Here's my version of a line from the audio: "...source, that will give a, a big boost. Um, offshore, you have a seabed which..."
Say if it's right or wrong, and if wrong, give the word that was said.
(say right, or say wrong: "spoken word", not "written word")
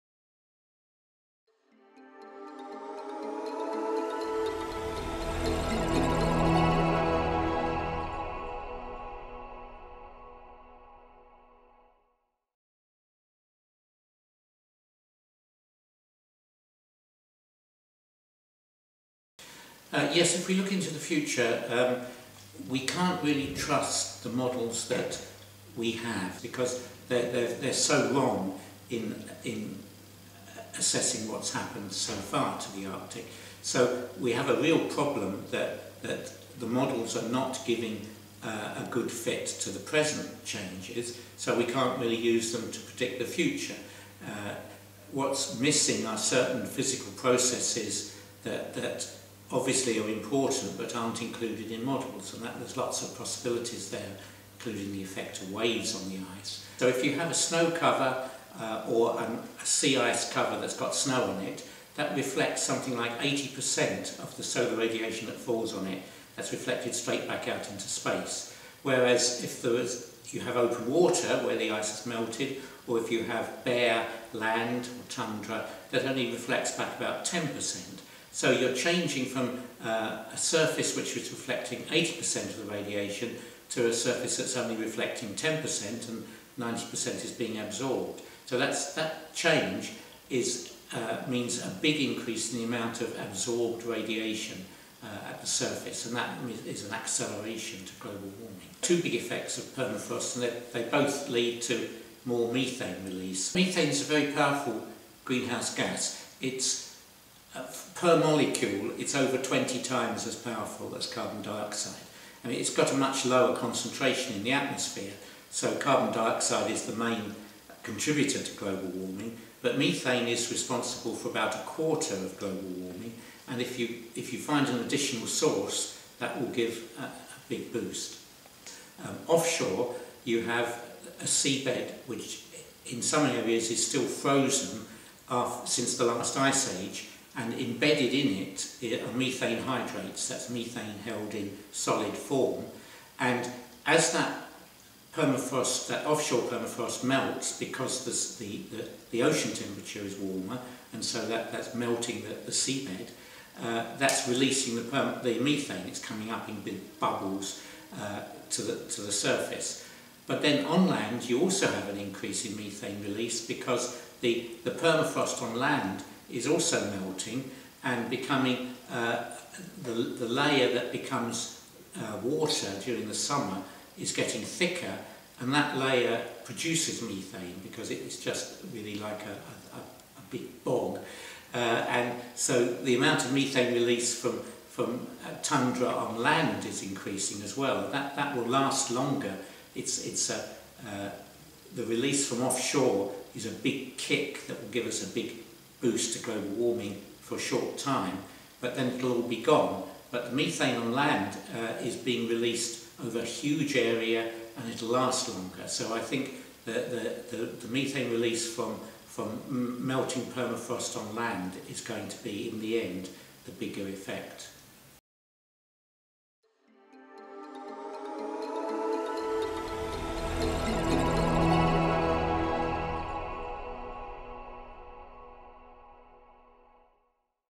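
right.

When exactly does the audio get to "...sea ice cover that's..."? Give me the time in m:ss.
0:59.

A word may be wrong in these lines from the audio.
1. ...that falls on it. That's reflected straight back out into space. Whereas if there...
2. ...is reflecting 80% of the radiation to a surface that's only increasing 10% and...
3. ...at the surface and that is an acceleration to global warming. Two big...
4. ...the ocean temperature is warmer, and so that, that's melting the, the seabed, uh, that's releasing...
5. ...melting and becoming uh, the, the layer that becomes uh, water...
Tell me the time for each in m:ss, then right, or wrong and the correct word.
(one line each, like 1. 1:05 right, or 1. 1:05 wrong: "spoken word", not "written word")
1. 1:05 right
2. 1:21 wrong: "reflecting", not "increasing"
3. 1:35 right
4. 2:29 right
5. 2:46 right.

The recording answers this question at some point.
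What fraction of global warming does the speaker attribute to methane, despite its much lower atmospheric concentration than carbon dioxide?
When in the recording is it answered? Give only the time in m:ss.
2:01.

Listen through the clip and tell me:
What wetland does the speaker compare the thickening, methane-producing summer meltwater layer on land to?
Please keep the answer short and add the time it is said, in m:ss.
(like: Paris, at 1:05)
a big bog, at 2:59.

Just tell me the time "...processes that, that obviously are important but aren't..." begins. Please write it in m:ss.
0:47.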